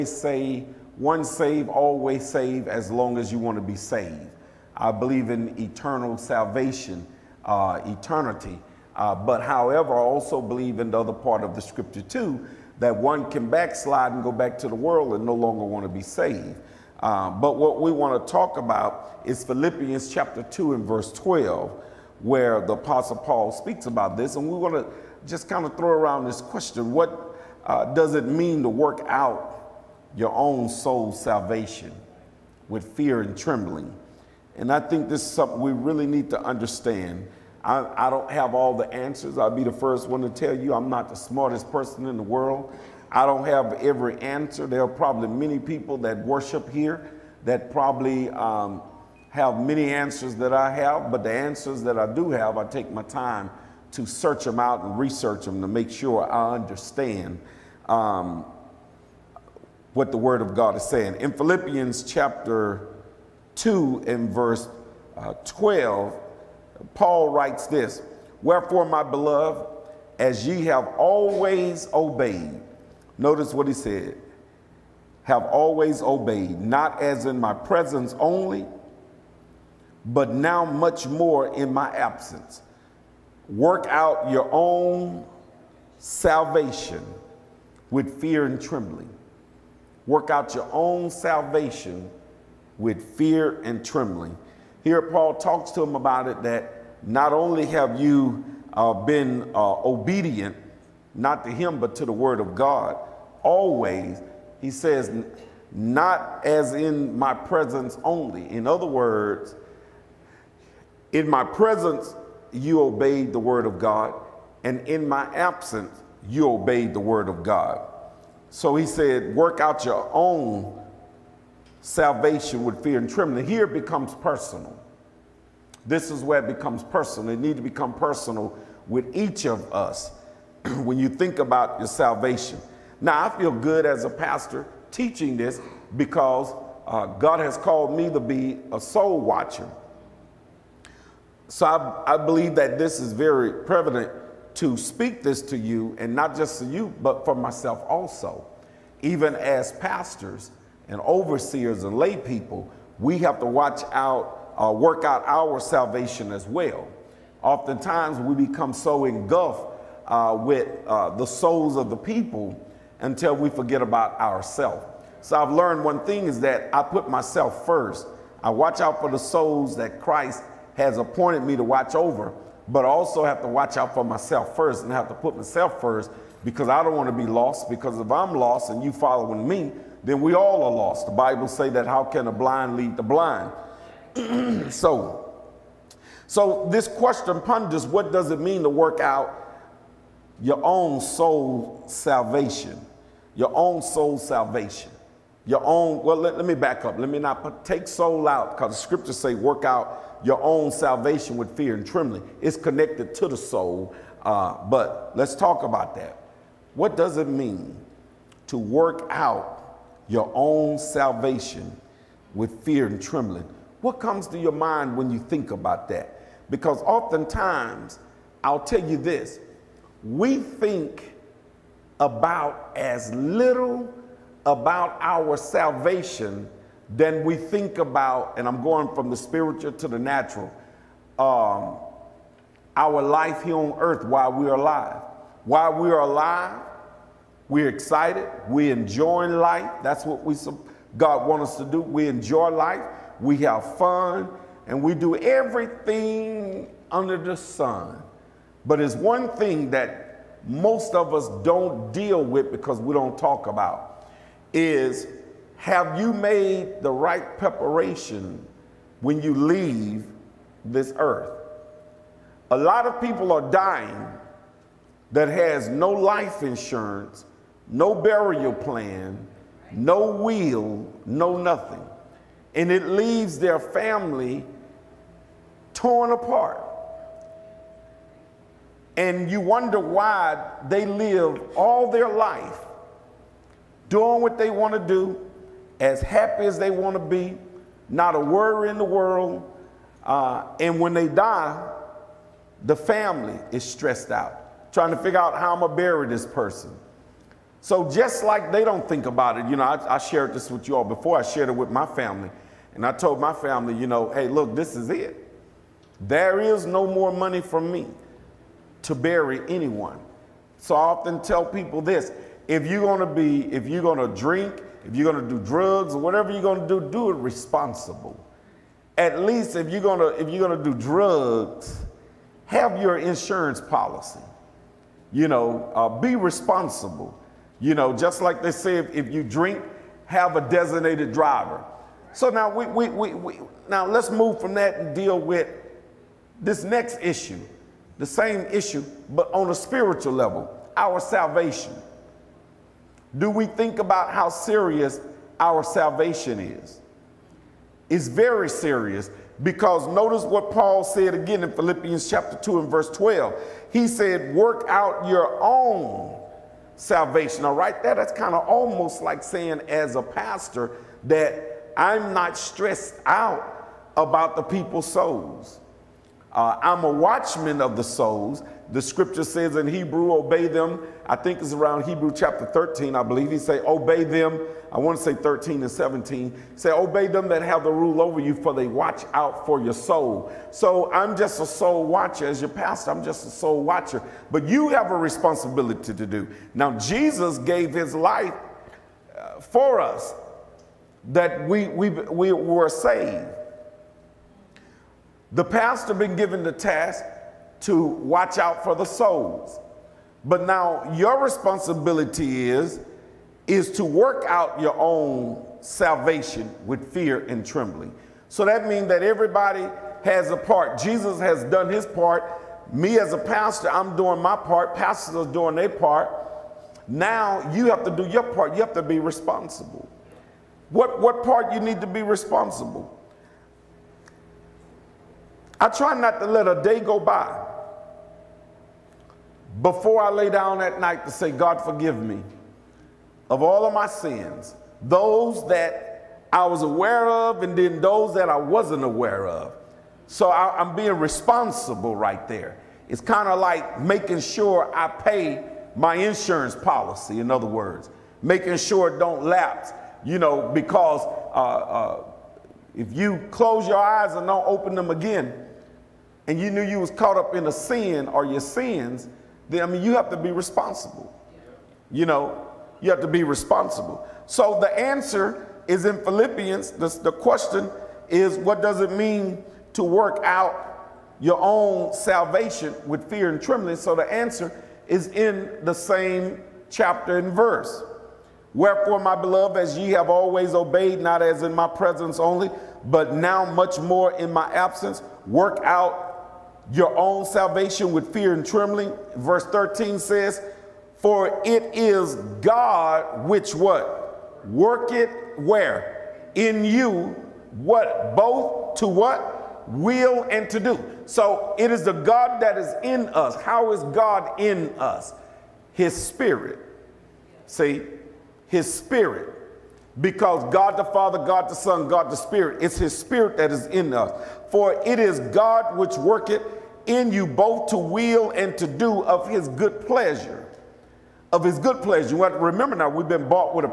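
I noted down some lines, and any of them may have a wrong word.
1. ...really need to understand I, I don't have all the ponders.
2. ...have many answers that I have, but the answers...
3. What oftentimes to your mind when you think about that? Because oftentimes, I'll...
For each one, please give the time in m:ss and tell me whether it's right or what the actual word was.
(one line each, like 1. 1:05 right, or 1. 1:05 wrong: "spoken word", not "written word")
1. 0:35 wrong: "answers", not "ponders"
2. 0:49 right
3. 3:33 wrong: "comes", not "oftentimes".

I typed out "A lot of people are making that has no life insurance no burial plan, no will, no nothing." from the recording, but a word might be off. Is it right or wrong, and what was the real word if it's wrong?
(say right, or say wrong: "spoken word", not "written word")
wrong: "dying", not "making".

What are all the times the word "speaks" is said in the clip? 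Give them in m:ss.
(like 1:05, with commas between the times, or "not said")
0:23, 2:24.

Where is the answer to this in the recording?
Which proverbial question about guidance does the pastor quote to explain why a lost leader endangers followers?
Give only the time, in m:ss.
3:02.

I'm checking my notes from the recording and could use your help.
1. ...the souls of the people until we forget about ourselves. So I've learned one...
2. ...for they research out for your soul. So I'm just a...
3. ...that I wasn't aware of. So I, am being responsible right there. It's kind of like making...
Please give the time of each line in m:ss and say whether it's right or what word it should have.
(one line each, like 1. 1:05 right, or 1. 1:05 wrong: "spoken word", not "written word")
1. 2:41 right
2. 6:18 wrong: "watch", not "research"
3. 7:18 right.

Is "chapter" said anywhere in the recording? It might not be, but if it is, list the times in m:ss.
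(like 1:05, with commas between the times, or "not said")
0:20, 1:02, 5:52, 6:12, 7:56.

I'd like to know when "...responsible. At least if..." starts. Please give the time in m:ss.
5:17.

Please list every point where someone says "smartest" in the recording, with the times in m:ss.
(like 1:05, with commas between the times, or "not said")
0:41.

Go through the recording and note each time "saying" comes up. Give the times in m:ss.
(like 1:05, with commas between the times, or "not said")
1:00, 5:59.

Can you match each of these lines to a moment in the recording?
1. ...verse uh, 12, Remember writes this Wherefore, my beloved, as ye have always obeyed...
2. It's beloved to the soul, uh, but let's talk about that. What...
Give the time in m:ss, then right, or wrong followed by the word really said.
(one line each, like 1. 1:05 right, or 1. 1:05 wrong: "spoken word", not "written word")
1. 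1:04 wrong: "Paul", not "Remember"
2. 3:22 wrong: "connected", not "beloved".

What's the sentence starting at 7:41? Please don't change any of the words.
You know, you have to be responsible.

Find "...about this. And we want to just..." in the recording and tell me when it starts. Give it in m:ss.
0:23.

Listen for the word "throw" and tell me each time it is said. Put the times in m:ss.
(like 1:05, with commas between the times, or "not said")
0:25.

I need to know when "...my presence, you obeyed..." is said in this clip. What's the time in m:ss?
1:51.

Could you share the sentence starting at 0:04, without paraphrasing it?
I believe in eternal salvation, uh, eternity.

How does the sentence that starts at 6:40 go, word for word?
But now your responsibility is is to work out your own salvation with fear and trembling.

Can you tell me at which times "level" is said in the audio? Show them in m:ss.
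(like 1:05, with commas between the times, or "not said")
5:40.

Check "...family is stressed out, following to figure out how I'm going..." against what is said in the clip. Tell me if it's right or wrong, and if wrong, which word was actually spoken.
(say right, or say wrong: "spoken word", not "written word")
wrong: "trying", not "following".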